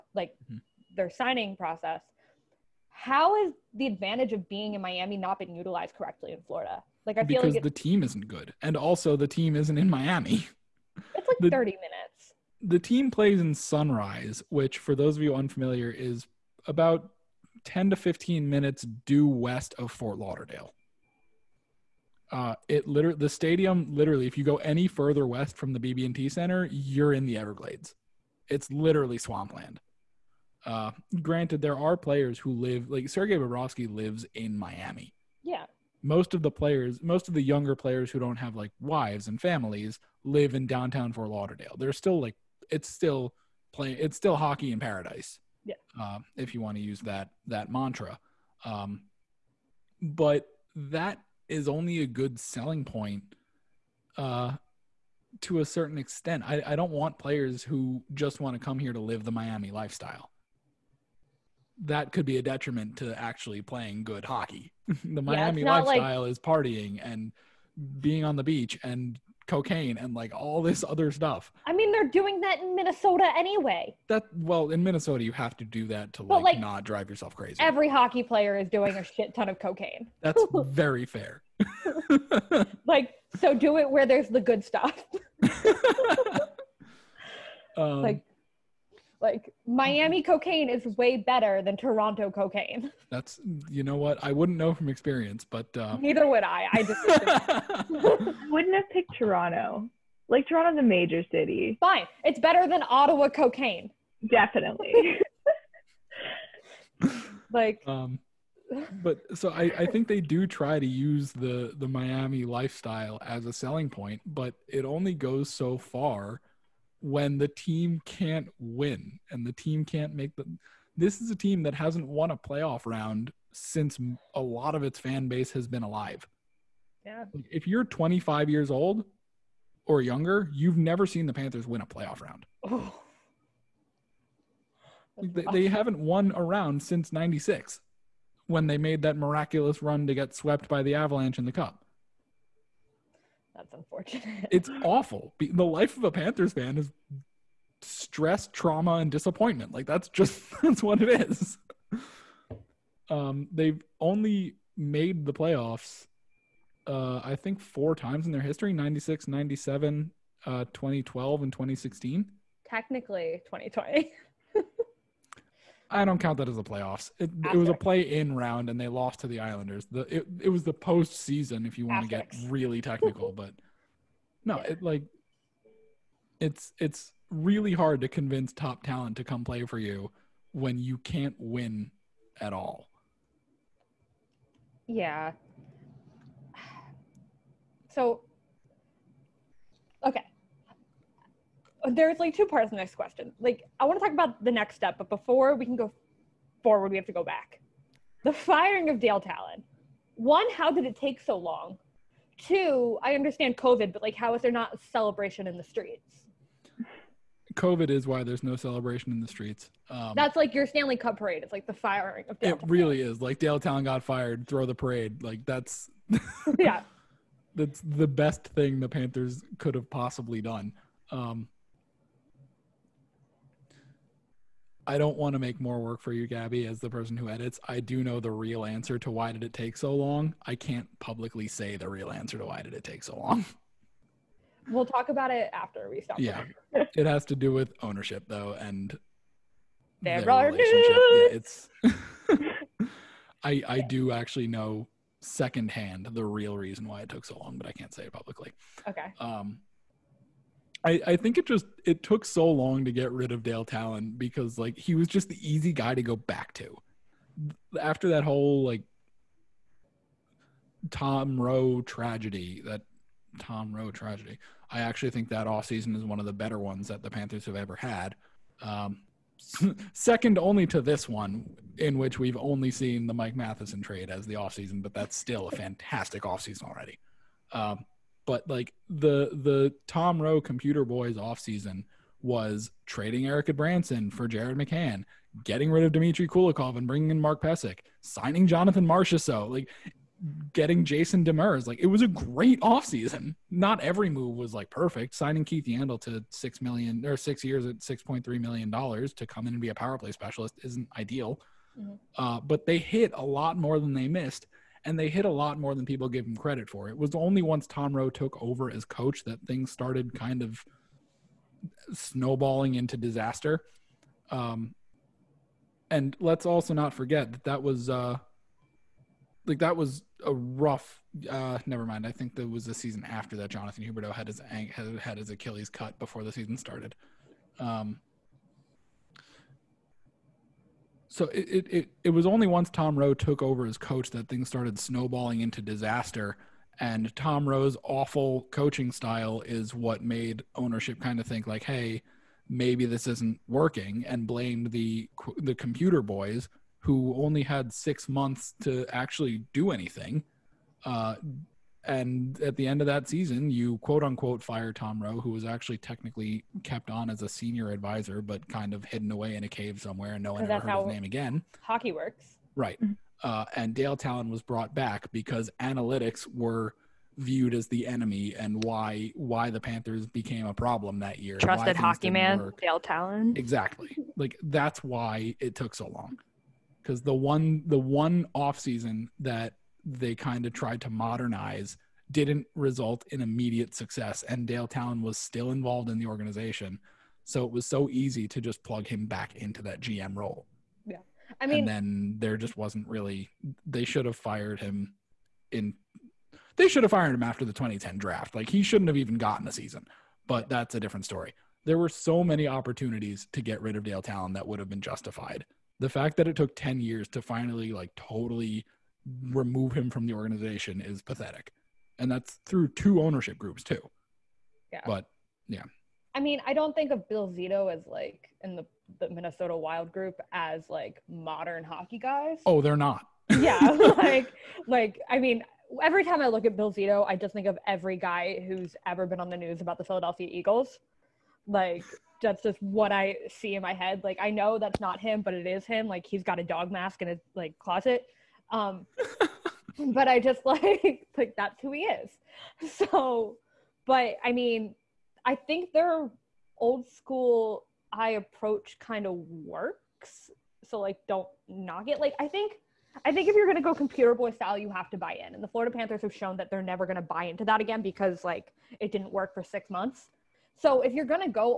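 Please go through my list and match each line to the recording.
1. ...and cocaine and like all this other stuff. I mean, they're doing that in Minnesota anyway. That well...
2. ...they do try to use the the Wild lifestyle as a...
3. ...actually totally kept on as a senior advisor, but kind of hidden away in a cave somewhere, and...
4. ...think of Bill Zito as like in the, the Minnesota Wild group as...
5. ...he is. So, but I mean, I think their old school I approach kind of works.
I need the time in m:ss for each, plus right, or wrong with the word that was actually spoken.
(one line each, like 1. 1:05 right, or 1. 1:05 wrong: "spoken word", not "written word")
1. 1:08 right
2. 1:50 wrong: "Miami", not "Wild"
3. 5:55 wrong: "technically", not "totally"
4. 6:56 right
5. 7:21 right.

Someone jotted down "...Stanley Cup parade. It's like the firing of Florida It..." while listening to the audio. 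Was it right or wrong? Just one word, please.
wrong.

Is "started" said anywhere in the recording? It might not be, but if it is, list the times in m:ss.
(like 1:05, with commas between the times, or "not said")
5:09, 5:26, 5:34.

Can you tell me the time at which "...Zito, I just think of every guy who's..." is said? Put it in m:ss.
7:06.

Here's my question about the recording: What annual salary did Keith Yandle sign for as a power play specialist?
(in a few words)
$6.3 million.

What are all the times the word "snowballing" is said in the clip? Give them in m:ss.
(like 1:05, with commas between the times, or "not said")
5:11, 5:34.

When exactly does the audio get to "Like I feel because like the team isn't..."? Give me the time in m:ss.
0:07.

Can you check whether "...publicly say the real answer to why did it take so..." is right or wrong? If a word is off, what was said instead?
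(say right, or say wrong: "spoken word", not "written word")
right.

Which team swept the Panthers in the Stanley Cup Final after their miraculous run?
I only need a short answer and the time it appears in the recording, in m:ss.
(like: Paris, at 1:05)
the Avalanche, at 2:20.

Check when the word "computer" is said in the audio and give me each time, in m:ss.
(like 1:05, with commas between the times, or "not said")
4:40, 5:45, 7:33.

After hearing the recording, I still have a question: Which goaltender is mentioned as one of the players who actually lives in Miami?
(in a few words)
Sergei Bobrovsky.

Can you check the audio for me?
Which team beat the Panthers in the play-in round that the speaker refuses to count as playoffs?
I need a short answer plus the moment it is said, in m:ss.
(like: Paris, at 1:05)
the Islanders, at 2:49.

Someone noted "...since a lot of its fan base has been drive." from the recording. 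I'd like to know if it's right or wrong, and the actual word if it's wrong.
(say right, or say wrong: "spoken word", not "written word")
wrong: "alive", not "drive".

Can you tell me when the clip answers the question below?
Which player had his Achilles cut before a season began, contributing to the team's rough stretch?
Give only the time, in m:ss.
5:23.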